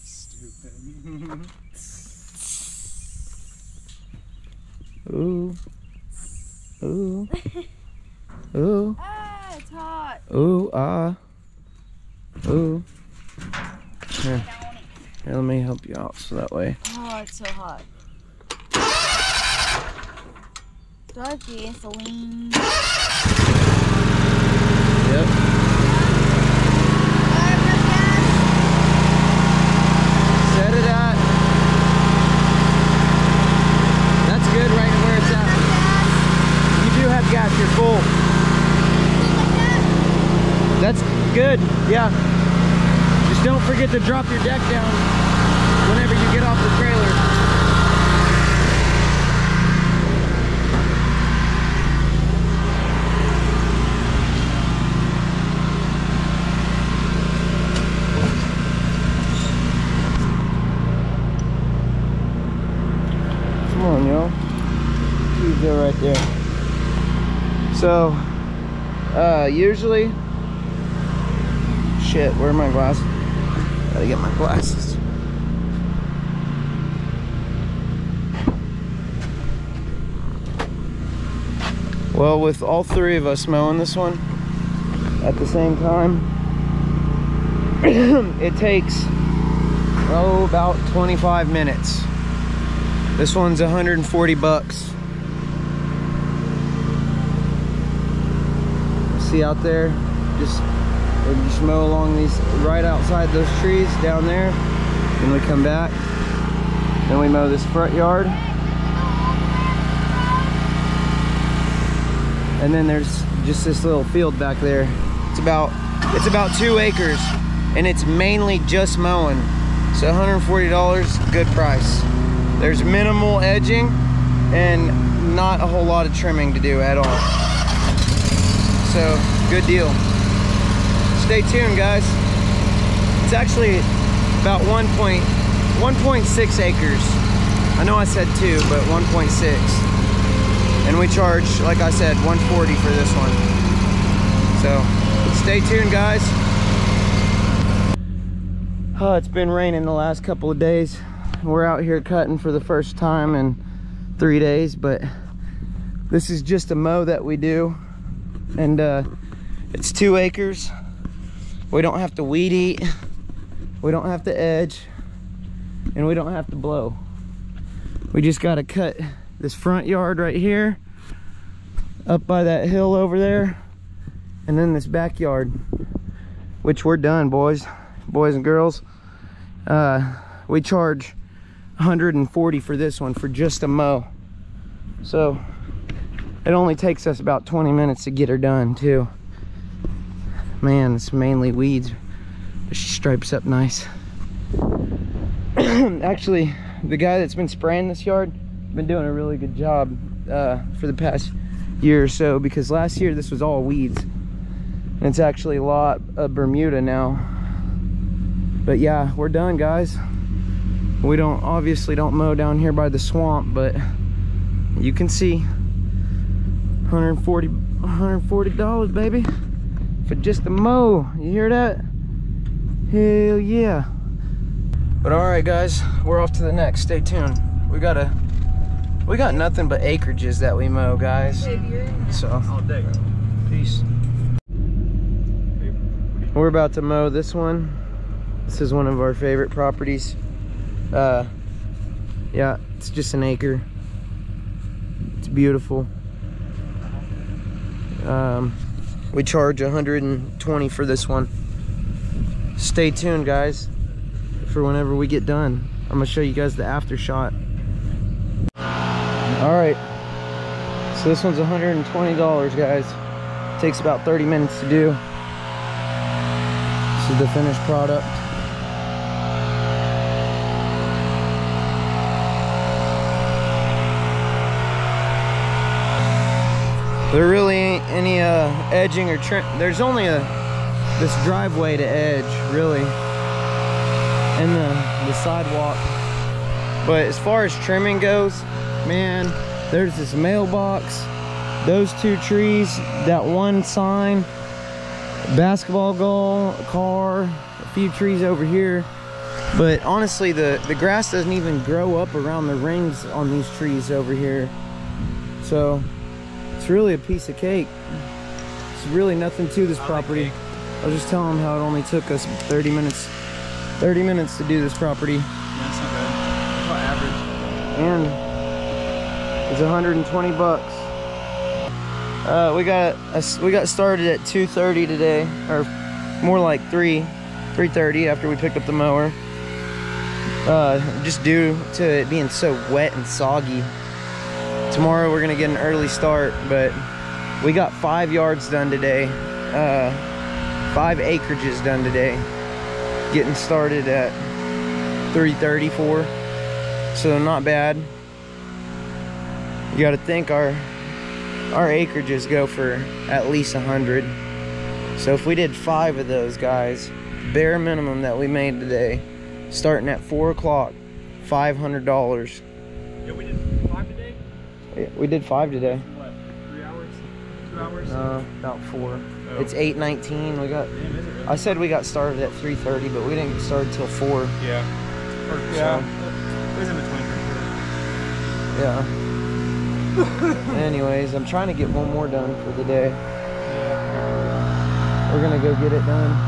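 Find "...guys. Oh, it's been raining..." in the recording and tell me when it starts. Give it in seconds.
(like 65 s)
145 s.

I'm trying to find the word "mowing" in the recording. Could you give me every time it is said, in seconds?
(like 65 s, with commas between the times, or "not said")
83 s, 118 s.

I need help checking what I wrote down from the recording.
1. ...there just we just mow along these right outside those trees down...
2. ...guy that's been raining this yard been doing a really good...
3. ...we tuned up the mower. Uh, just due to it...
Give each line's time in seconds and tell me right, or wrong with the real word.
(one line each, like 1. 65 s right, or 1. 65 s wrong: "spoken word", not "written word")
1. 99 s right
2. 196 s wrong: "spraying", not "raining"
3. 328 s wrong: "picked", not "tuned".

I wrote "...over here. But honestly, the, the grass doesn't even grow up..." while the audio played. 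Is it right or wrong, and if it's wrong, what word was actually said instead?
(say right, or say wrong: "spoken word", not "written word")
right.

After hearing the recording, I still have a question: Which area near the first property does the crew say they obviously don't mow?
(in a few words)
the swamp.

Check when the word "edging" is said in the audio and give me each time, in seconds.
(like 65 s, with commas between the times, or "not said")
123 s, 278 s.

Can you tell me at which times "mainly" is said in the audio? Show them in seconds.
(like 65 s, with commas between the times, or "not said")
118 s, 191 s.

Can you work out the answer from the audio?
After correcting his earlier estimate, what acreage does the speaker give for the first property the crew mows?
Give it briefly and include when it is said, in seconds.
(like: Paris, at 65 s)
1.6 acres, at 138 s.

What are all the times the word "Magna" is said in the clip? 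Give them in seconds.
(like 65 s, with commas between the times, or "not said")
not said.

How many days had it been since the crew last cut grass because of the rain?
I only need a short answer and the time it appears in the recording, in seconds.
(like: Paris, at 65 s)
3 days, at 154 s.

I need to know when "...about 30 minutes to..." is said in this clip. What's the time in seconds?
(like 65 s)
263 s.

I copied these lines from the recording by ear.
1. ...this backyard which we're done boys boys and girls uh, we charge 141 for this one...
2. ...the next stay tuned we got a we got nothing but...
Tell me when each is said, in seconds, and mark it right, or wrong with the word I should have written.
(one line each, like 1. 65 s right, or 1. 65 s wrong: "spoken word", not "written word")
1. 174 s wrong: "140", not "141"
2. 226 s right.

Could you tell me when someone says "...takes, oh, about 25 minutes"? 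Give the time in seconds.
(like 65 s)
88 s.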